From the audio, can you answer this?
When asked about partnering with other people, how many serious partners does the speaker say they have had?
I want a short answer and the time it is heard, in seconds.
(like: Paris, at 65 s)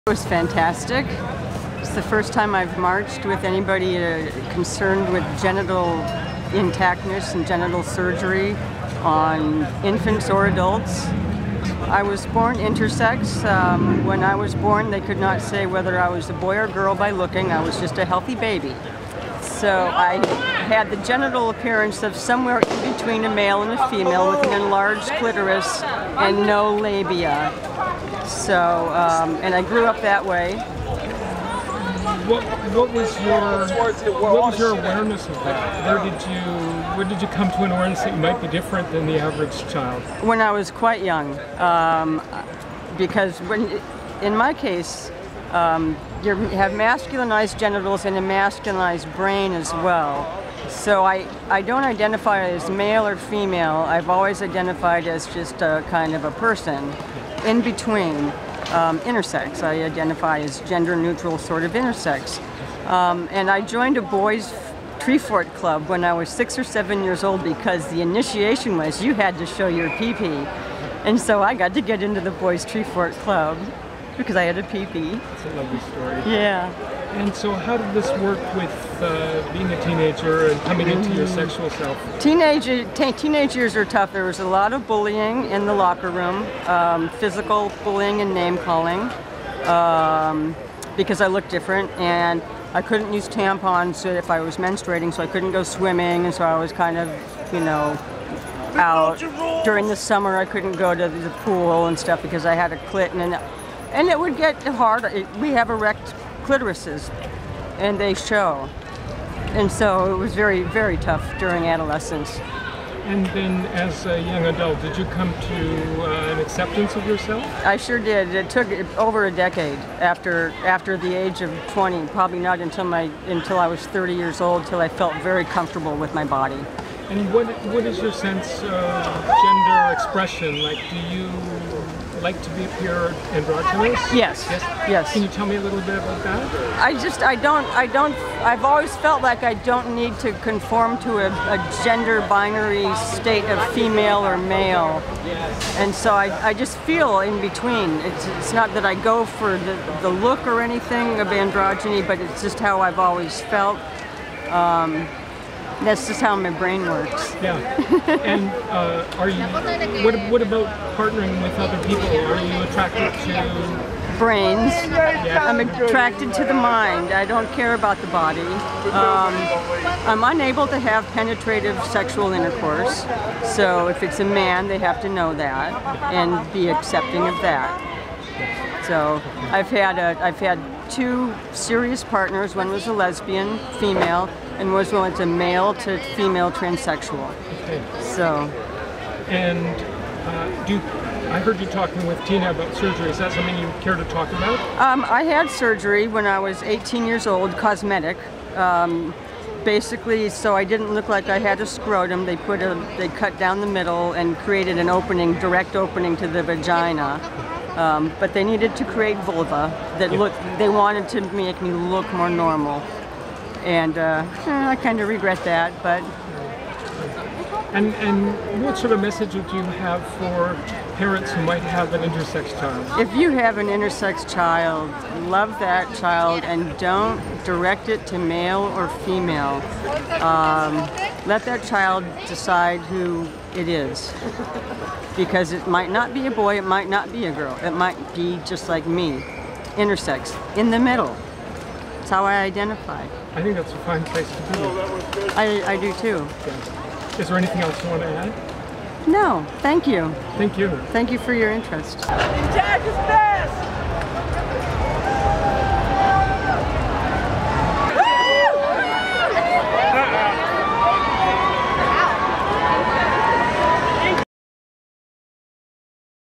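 2, at 180 s.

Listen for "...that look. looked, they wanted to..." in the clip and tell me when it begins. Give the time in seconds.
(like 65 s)
209 s.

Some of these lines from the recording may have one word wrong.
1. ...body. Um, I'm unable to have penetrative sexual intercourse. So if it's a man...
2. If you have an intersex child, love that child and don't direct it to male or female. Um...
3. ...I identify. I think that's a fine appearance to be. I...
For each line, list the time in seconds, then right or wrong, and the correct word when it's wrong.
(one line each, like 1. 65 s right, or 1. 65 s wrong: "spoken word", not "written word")
1. 168 s right
2. 222 s right
3. 242 s wrong: "place", not "appearance".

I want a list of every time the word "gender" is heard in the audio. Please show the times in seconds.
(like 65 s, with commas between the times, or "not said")
60 s, 129 s, 141 s.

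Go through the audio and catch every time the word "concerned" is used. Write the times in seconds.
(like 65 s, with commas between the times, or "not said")
4 s.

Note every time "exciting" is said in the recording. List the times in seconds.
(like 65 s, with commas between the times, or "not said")
not said.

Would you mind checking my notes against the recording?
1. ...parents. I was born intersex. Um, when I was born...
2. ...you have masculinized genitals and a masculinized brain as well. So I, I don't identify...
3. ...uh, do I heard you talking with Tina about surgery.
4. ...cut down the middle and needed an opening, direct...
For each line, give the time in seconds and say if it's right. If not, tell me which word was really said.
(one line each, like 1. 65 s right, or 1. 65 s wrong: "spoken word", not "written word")
1. 10 s wrong: "adults", not "parents"
2. 46 s right
3. 190 s right
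4. 203 s wrong: "created", not "needed".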